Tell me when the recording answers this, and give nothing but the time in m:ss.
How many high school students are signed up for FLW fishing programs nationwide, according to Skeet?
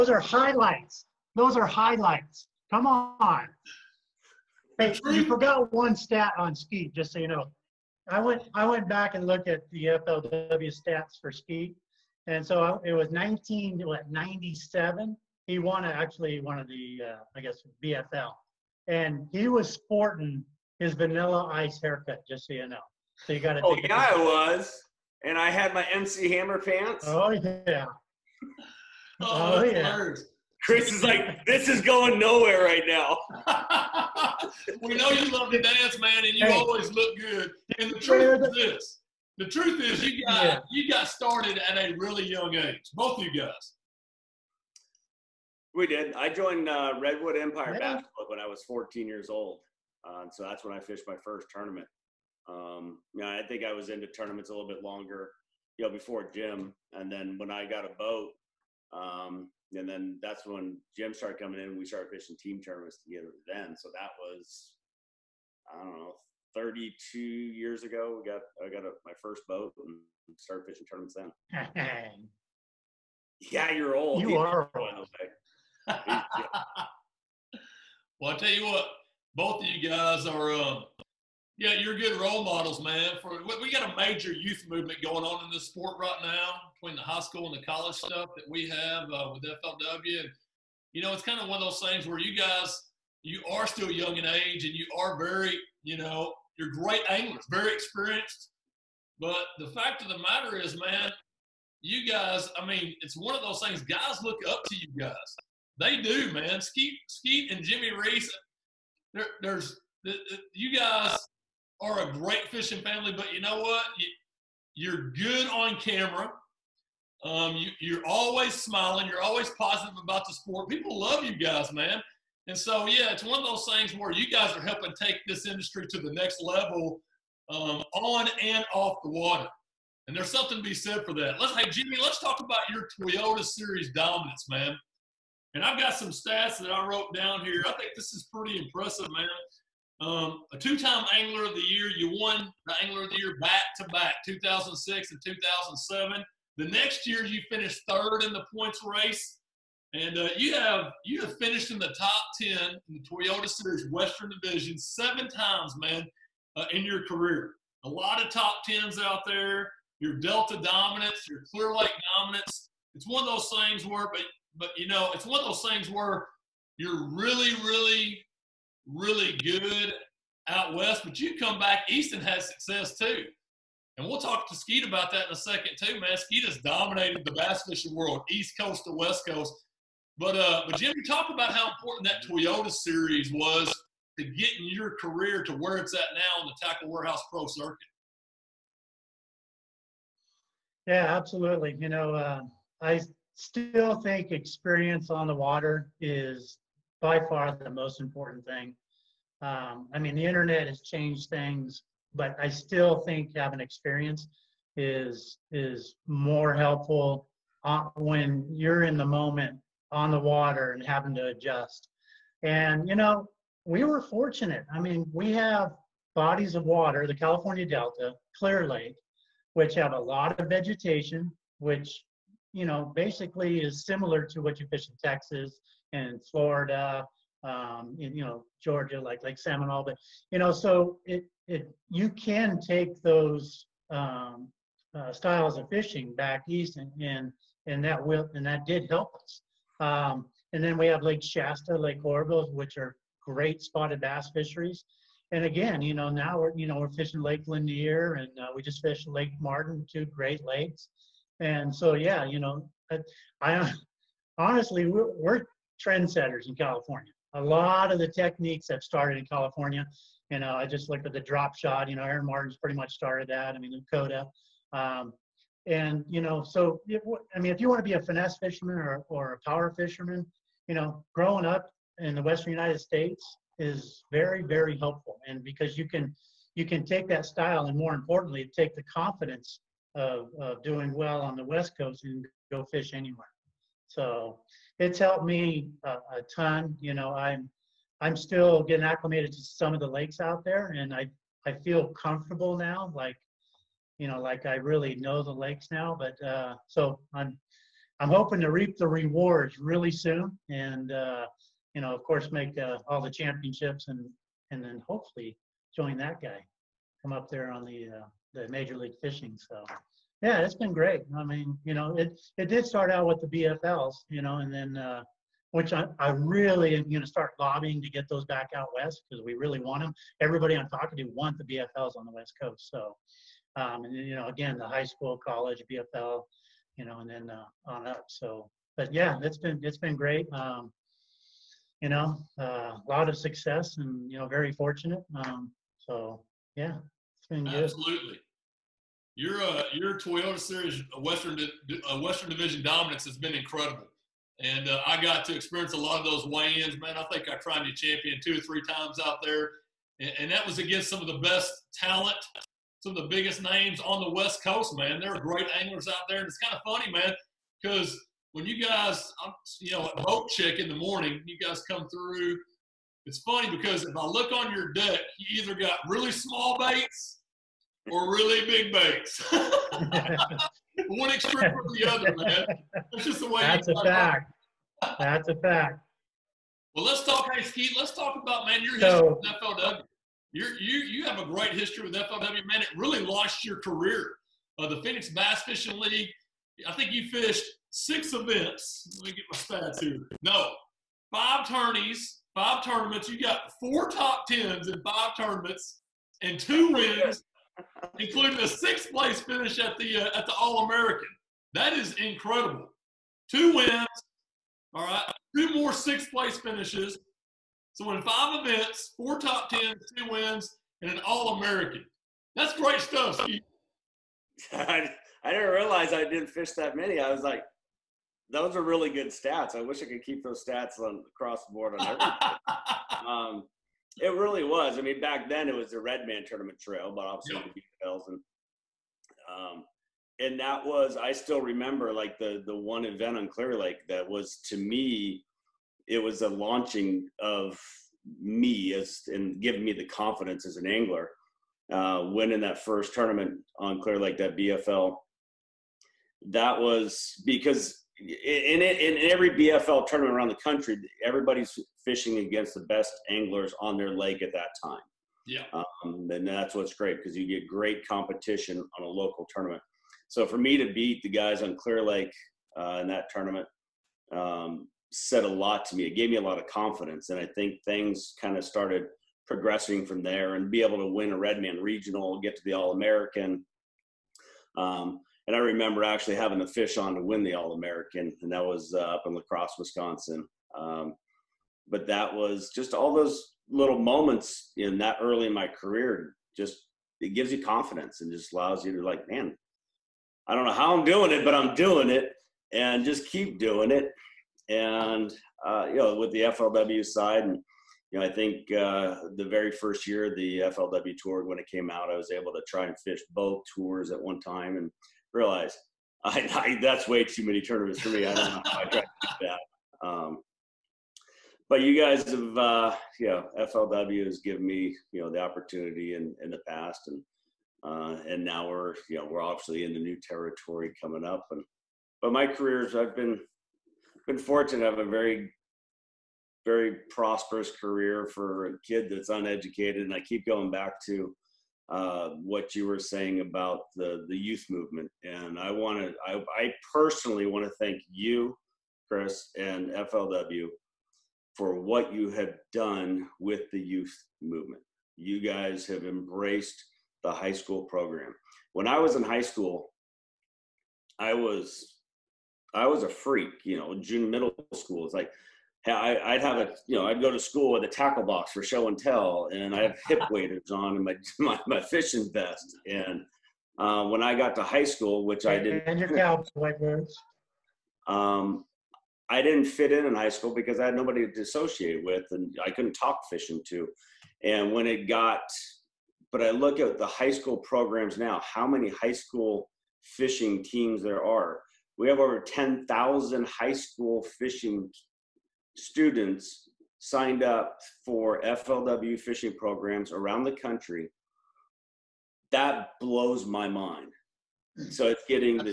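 9:42.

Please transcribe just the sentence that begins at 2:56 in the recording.
Skeet has dominated the bass fishing world, east coast to west coast.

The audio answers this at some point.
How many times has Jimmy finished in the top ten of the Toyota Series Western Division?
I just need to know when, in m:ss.
2:34.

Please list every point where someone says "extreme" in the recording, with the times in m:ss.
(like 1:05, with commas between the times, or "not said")
6:11.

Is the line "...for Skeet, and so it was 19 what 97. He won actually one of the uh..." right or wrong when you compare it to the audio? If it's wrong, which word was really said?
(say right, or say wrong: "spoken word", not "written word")
right.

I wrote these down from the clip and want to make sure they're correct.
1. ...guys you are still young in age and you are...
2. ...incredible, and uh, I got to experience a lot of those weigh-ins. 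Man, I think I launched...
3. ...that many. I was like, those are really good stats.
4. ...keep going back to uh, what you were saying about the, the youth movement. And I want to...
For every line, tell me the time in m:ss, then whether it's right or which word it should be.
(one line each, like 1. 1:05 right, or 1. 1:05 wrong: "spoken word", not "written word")
1. 1:32 right
2. 5:43 wrong: "tried", not "launched"
3. 6:56 right
4. 8:50 right.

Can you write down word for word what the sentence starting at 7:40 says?
So for me to beat the guys on Clear Lake uh, in that tournament um, said a lot to me.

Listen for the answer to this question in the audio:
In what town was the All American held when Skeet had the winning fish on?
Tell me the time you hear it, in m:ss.
7:59.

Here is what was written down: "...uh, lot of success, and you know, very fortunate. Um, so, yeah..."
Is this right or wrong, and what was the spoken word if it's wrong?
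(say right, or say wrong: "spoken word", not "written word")
right.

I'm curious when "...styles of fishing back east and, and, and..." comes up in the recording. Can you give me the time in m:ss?
3:55.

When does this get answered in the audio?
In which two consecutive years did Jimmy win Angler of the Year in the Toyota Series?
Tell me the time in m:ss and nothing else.
2:24.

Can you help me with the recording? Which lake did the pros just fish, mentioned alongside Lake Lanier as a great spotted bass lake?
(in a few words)
Lake Martin.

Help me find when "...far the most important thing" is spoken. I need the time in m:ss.
3:17.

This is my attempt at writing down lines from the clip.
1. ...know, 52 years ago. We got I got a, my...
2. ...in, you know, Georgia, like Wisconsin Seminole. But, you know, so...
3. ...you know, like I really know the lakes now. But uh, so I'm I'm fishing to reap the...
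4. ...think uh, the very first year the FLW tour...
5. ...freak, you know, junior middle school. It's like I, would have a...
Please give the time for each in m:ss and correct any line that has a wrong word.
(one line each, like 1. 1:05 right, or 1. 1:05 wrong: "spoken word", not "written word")
1. 1:05 wrong: "32", not "52"
2. 3:47 wrong: "Lake", not "Wisconsin"
3. 4:53 wrong: "hoping", not "fishing"
4. 8:18 right
5. 9:12 right.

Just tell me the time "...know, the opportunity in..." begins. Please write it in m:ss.
8:35.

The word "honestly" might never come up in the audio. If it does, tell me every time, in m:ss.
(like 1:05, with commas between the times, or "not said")
4:14.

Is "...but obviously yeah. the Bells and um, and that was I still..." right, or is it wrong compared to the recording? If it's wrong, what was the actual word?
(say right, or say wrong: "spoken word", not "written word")
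right.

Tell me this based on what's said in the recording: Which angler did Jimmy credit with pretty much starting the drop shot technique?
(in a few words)
Aaron Martens.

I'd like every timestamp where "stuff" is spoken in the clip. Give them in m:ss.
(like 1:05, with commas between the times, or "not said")
1:27, 6:52.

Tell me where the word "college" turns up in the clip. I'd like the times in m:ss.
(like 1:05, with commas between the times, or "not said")
1:27, 5:25.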